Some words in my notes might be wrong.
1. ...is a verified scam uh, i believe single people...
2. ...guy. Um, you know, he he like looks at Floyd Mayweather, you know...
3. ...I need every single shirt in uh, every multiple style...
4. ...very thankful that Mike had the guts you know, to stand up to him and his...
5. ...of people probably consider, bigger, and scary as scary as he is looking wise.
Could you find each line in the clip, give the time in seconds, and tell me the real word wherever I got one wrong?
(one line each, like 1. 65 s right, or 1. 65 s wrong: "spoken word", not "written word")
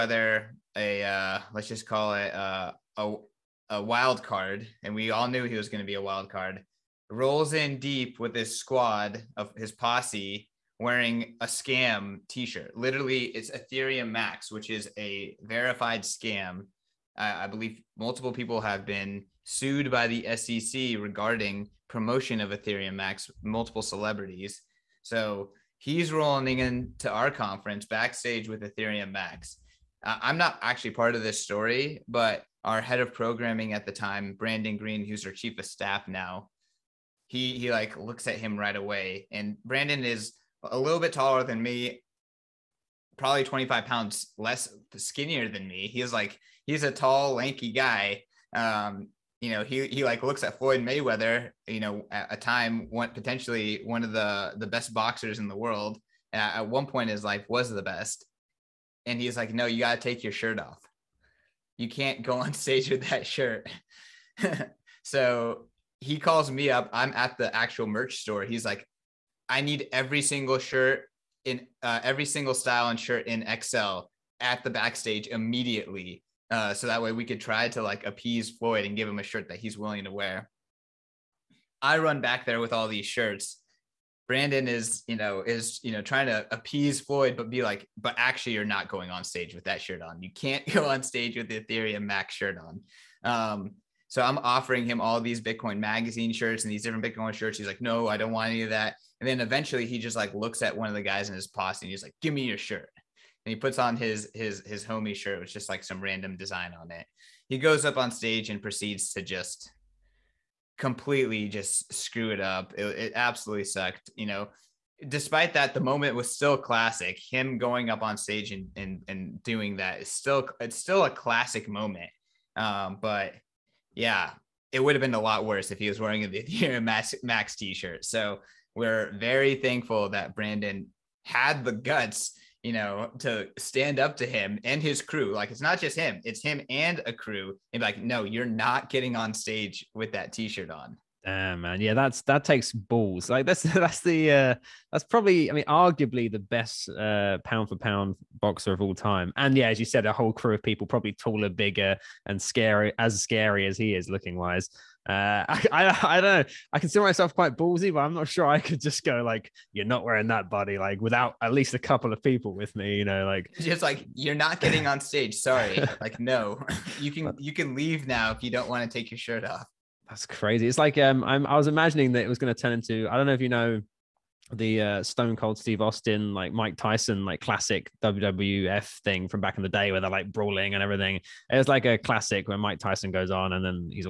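1. 14 s wrong: "multiple", not "single"
2. 47 s right
3. 69 s wrong: "single", not "multiple"
4. 129 s wrong: "Brandon", not "Mike"
5. 150 s wrong: "taller", not "consider".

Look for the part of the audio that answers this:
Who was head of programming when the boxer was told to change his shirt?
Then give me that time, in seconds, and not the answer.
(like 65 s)
34 s.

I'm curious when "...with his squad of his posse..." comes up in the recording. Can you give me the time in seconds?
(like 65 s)
8 s.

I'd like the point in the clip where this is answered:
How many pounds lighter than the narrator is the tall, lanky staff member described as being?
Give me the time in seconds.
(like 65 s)
43 s.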